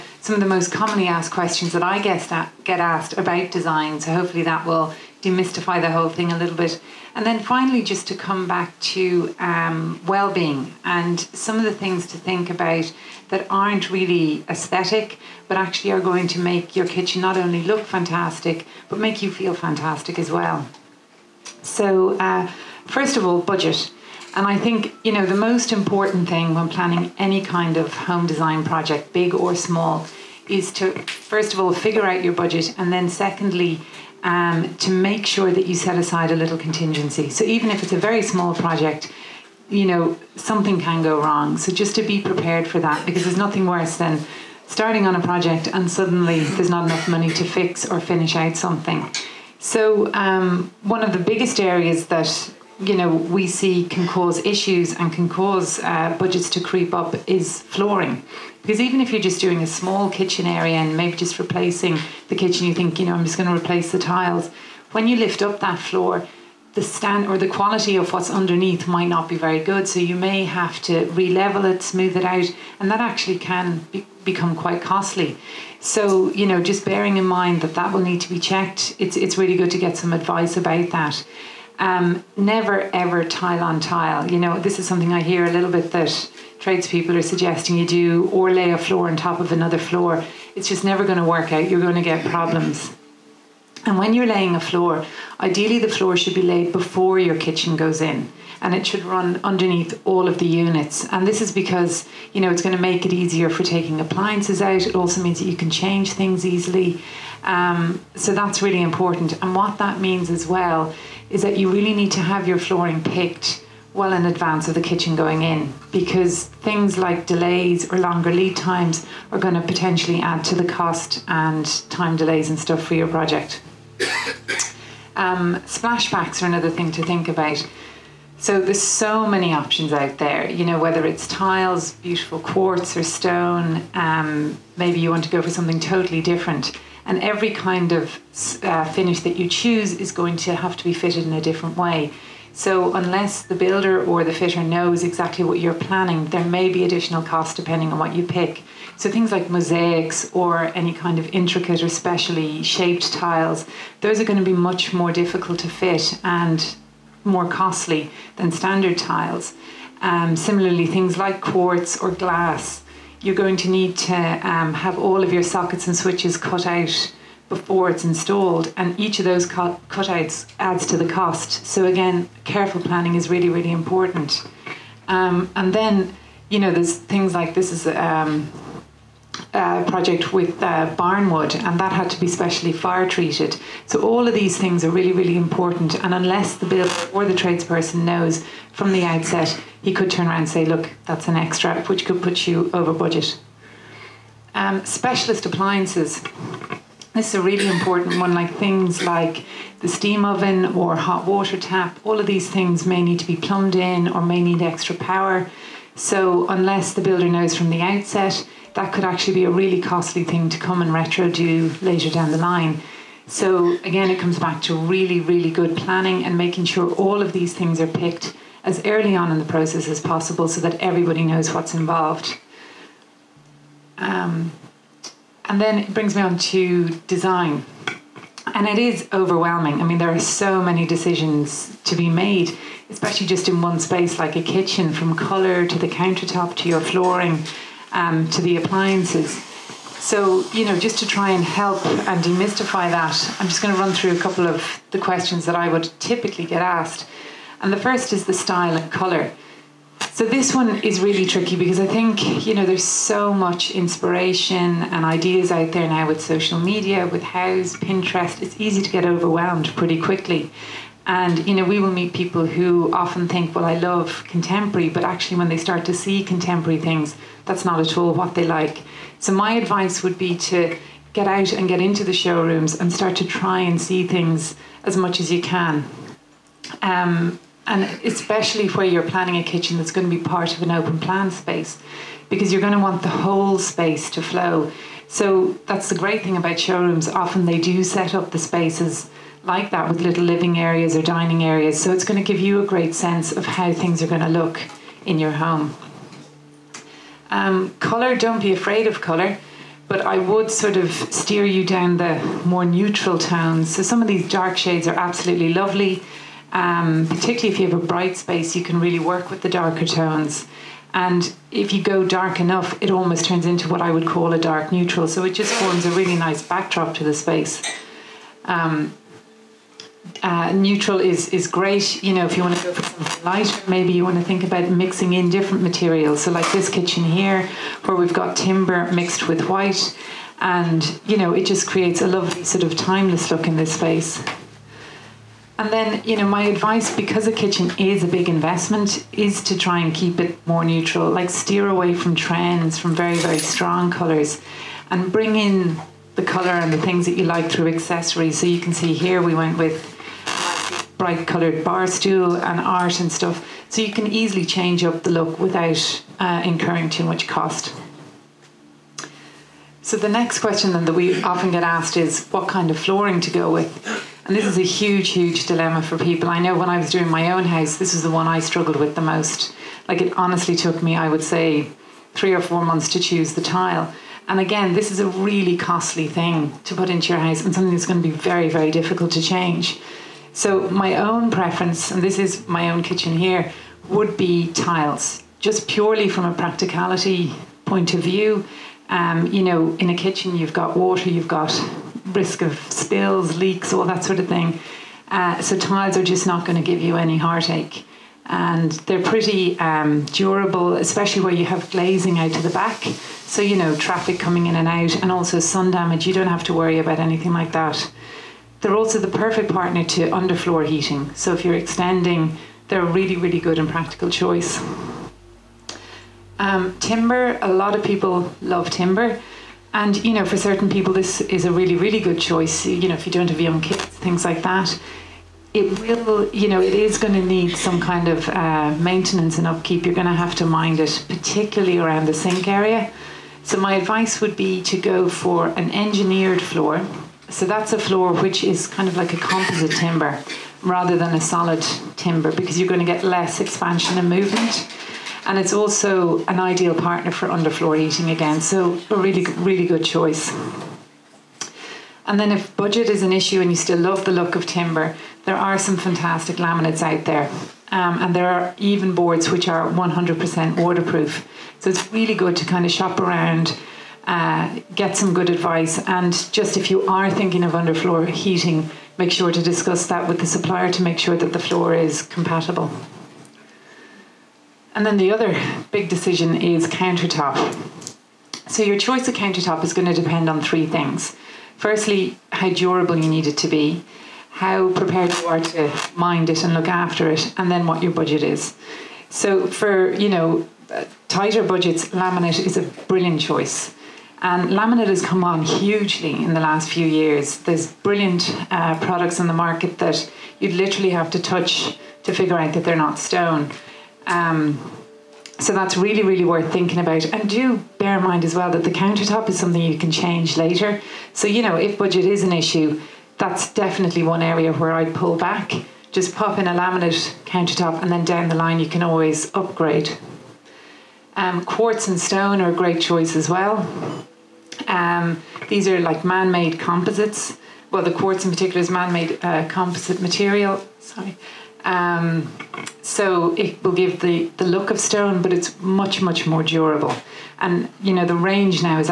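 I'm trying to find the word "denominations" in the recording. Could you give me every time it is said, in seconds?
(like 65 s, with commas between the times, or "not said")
not said.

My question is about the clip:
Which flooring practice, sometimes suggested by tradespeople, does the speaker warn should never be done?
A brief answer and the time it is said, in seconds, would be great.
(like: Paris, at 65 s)
Tile on tile, at 83 s.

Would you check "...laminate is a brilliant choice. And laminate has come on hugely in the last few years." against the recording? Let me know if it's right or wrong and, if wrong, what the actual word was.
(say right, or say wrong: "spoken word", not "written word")
right.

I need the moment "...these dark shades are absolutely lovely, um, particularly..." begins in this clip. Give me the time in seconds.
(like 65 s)
304 s.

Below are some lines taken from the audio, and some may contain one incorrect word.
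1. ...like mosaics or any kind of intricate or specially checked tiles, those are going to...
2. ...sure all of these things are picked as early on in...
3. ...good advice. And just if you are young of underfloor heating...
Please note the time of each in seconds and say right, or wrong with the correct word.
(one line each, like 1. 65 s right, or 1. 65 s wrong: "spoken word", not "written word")
1. 149 s wrong: "shaped", not "checked"
2. 216 s right
3. 465 s wrong: "thinking", not "young".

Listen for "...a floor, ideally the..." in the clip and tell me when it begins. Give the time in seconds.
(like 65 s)
94 s.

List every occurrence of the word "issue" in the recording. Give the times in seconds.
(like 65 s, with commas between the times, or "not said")
54 s, 453 s, 512 s.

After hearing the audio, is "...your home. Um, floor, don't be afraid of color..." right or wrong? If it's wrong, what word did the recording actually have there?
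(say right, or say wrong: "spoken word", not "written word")
wrong: "color", not "floor".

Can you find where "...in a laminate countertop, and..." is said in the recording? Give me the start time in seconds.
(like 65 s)
516 s.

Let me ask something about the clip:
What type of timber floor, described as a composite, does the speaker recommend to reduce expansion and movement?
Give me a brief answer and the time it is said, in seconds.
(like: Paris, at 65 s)
Engineered floor, at 435 s.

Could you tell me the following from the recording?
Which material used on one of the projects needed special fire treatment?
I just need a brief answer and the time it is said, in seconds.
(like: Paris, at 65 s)
Barnwood, at 180 s.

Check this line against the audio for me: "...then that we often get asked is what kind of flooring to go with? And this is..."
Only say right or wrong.
right.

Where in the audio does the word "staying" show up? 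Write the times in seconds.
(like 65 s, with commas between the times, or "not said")
not said.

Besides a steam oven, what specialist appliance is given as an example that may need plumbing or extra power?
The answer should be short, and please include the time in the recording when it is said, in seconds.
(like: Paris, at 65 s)
Hot water tap, at 200 s.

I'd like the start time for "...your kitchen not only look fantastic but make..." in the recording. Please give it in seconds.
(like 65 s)
16 s.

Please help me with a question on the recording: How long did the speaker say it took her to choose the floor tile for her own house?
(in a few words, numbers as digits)
3 or 4 months.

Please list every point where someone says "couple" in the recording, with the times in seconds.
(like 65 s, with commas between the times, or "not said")
244 s.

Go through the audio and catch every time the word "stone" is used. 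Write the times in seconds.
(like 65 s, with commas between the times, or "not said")
133 s, 502 s, 521 s, 534 s.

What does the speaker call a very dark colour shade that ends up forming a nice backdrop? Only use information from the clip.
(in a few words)
Dark neutral.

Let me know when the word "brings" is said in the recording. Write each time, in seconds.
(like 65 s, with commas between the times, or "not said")
225 s, 345 s.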